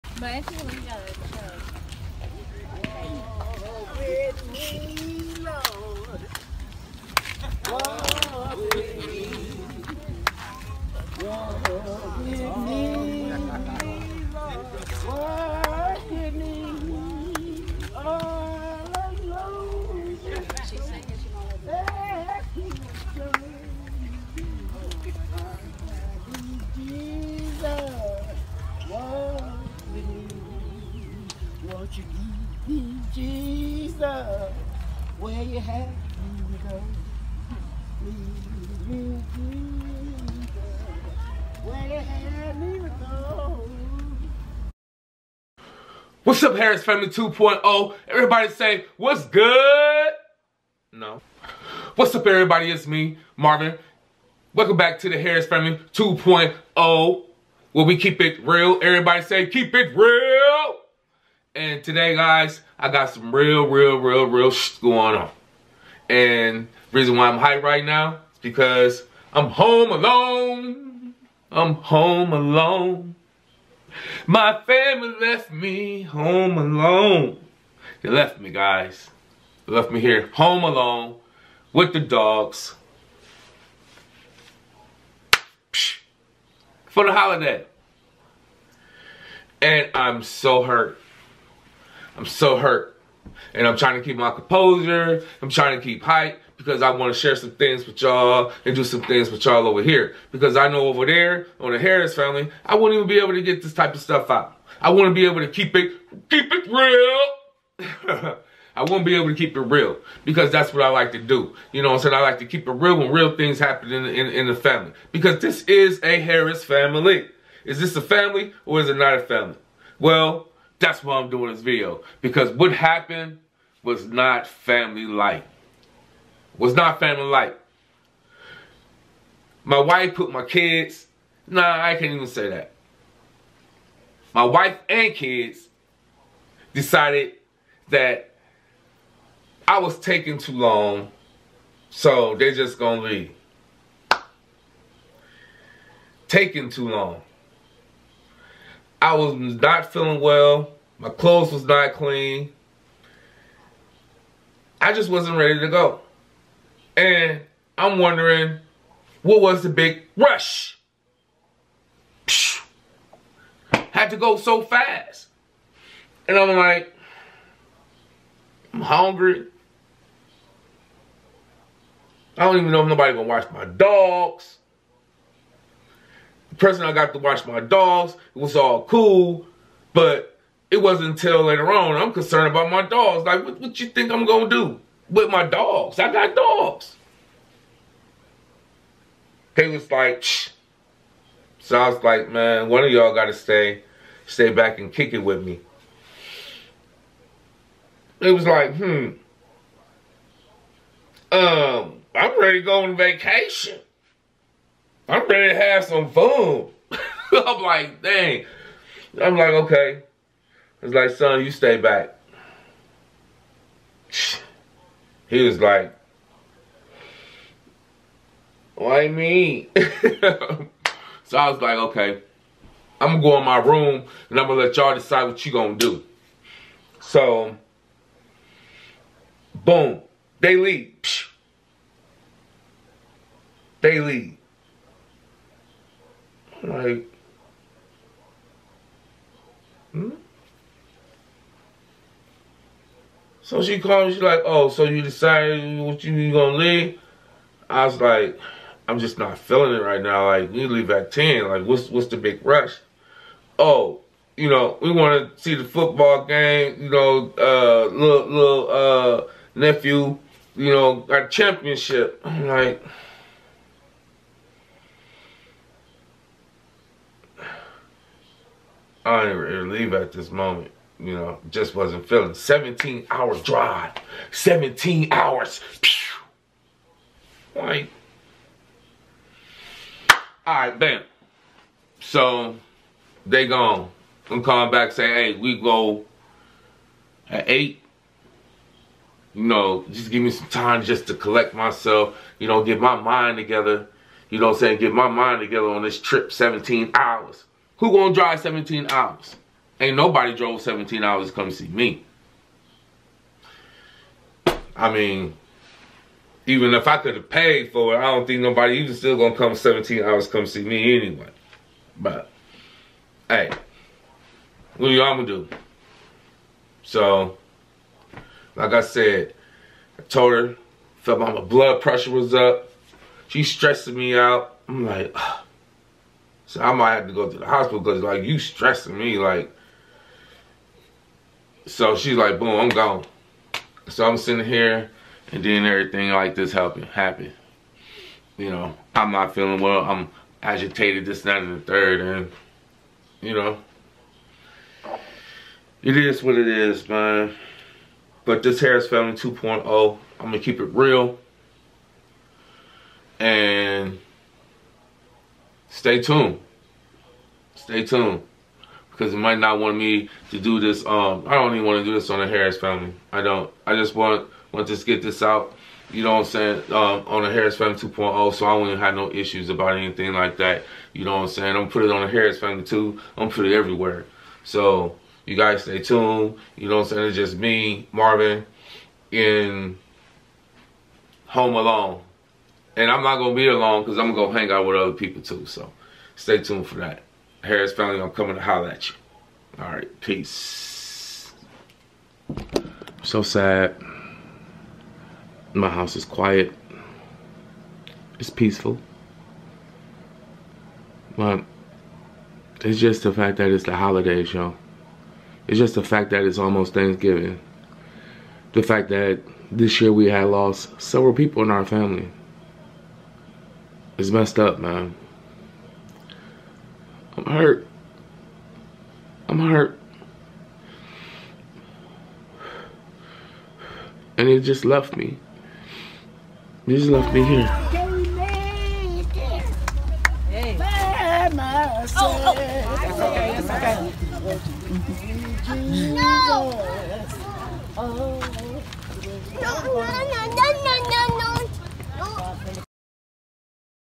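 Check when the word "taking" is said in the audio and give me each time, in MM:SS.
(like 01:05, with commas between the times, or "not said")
02:19, 02:26.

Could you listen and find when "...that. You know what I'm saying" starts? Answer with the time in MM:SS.
06:10.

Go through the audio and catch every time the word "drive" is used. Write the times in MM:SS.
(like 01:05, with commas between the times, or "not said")
04:33, 04:58.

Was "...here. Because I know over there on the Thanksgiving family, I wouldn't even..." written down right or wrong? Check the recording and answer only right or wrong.
wrong.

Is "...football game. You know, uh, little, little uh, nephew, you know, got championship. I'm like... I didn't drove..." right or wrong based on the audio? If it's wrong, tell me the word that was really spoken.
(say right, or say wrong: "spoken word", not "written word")
wrong: "relieve", not "drove".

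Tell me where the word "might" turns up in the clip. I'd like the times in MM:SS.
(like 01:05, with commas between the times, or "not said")
05:26, 05:59.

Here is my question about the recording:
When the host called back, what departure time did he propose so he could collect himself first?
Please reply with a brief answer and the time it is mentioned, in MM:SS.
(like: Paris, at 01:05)
8, at 04:47.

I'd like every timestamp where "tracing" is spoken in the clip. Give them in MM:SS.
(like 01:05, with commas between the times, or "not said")
not said.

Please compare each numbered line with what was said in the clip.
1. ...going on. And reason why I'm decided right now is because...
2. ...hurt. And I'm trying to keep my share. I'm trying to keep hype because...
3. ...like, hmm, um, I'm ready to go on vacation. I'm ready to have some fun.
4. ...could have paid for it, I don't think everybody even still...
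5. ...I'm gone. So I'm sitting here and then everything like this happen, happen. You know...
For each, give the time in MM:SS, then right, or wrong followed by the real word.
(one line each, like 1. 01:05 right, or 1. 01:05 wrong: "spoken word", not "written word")
1. 01:04 wrong: "hyped", not "decided"
2. 01:32 wrong: "composure", not "share"
3. 03:18 right
4. 05:06 wrong: "nobody", not "everybody"
5. 05:32 right.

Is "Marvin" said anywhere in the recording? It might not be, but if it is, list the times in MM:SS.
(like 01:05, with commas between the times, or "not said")
00:53, 06:17.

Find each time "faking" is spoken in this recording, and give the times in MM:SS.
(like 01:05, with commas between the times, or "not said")
not said.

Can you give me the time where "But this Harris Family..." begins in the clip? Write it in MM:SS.
05:48.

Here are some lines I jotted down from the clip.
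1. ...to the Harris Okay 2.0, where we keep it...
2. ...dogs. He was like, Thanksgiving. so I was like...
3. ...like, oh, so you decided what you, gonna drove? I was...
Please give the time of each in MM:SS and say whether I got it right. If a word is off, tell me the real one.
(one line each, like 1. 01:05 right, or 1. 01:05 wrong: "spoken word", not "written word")
1. 00:54 wrong: "Family", not "Okay"
2. 03:06 wrong: "Shh", not "Thanksgiving"
3. 04:04 wrong: "leave", not "drove".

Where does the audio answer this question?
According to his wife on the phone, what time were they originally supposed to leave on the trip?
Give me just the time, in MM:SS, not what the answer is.
04:11.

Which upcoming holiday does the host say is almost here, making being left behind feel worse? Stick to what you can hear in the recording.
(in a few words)
Thanksgiving.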